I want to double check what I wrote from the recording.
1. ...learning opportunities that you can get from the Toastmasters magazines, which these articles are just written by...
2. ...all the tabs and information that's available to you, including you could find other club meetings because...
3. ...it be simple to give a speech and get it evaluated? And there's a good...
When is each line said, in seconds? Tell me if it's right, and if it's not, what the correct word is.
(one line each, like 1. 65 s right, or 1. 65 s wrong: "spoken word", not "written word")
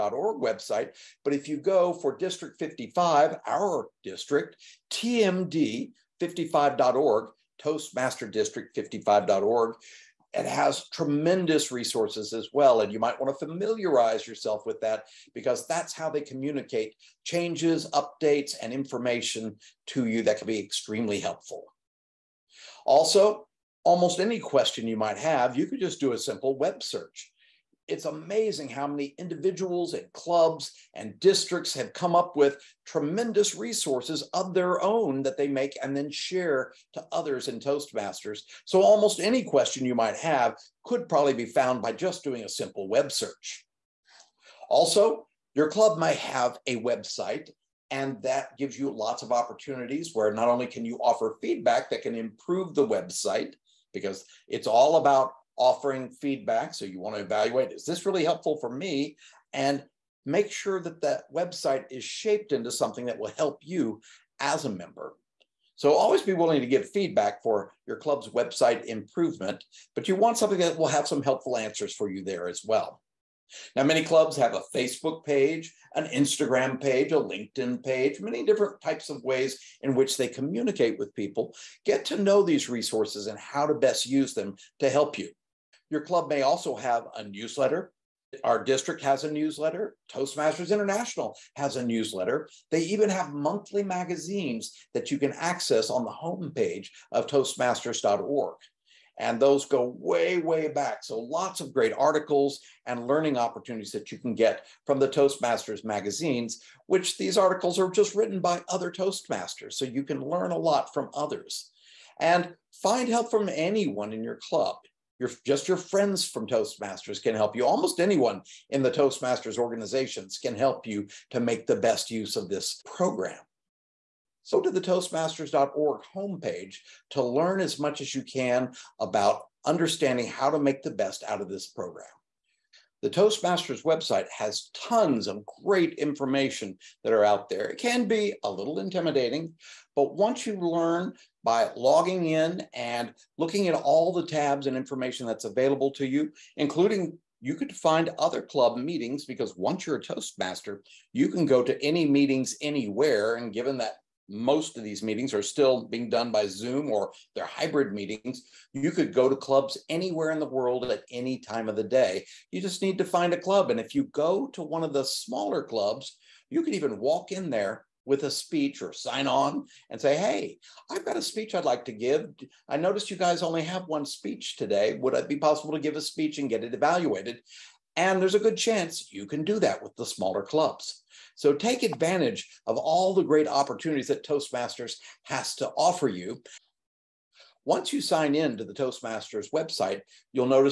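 1. 103 s right
2. 143 s right
3. 175 s wrong: "possible", not "simple".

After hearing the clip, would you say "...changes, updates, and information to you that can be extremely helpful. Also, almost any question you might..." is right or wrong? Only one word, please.
right.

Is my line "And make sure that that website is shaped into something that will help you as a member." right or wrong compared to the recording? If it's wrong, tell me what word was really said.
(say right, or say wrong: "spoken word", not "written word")
right.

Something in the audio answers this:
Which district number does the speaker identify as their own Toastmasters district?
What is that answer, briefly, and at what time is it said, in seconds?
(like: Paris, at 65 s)
55, at 2 s.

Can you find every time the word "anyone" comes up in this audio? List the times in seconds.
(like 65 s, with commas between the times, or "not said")
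113 s, 117 s.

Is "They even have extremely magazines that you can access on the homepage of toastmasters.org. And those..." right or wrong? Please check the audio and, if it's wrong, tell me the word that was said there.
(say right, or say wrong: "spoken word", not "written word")
wrong: "monthly", not "extremely".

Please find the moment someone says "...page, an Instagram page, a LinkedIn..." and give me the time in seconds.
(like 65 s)
75 s.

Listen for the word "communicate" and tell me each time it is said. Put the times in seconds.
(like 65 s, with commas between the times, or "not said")
16 s, 80 s.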